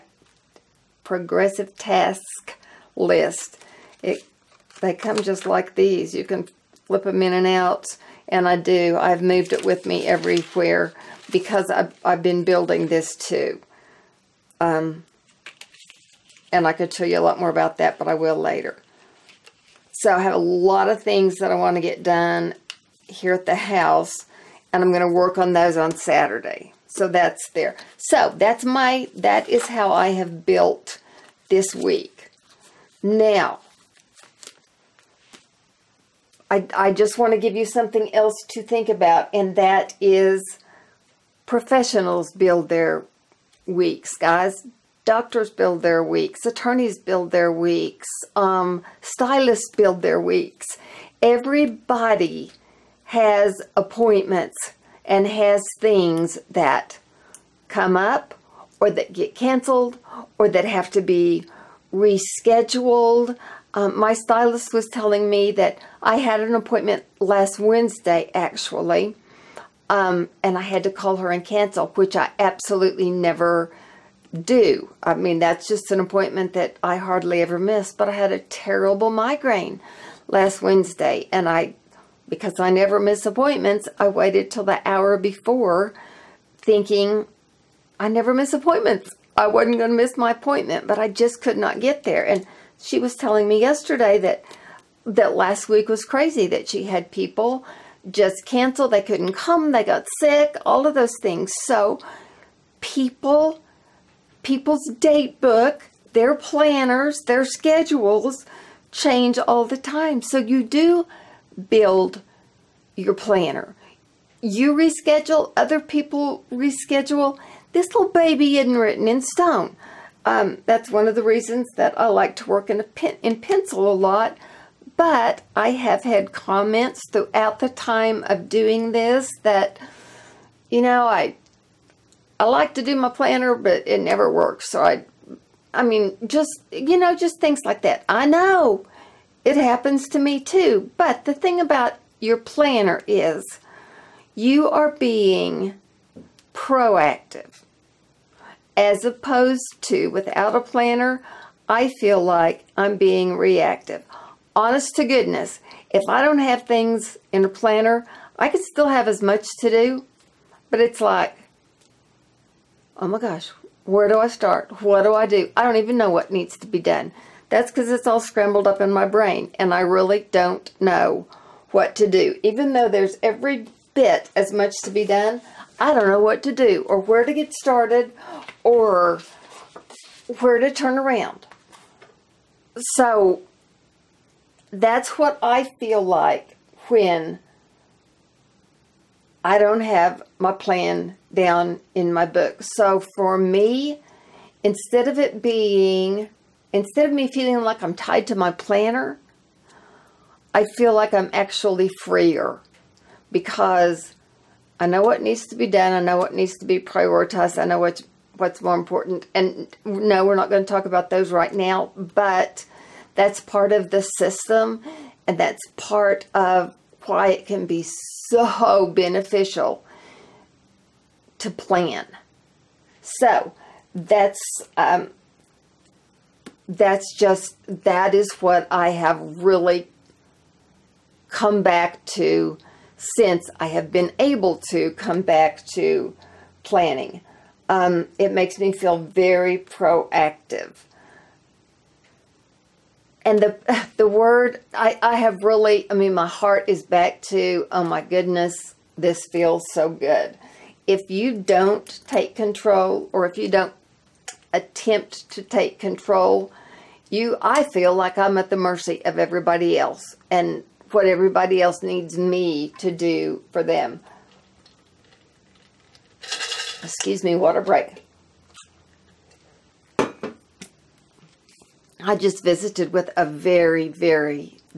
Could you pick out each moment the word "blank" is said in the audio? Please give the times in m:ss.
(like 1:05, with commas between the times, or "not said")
not said.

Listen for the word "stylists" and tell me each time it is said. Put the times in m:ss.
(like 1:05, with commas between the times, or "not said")
0:49, 1:04.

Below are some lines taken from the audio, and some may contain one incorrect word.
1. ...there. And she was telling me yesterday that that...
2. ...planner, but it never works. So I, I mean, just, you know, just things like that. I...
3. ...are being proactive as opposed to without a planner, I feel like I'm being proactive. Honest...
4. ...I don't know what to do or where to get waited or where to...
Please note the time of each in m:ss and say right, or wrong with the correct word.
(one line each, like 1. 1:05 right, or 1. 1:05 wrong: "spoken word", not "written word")
1. 1:32 right
2. 2:13 right
3. 2:24 wrong: "reactive", not "proactive"
4. 2:55 wrong: "started", not "waited".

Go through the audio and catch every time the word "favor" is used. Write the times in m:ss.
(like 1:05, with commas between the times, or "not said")
not said.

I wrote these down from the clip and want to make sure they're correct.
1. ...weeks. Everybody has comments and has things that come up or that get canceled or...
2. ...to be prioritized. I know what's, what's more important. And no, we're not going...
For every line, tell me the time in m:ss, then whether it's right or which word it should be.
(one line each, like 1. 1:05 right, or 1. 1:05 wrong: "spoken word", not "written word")
1. 0:50 wrong: "appointments", not "comments"
2. 3:26 right.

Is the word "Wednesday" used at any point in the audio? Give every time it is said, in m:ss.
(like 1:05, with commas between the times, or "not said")
1:07, 1:20.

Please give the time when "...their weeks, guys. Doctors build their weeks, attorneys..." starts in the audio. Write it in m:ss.
0:42.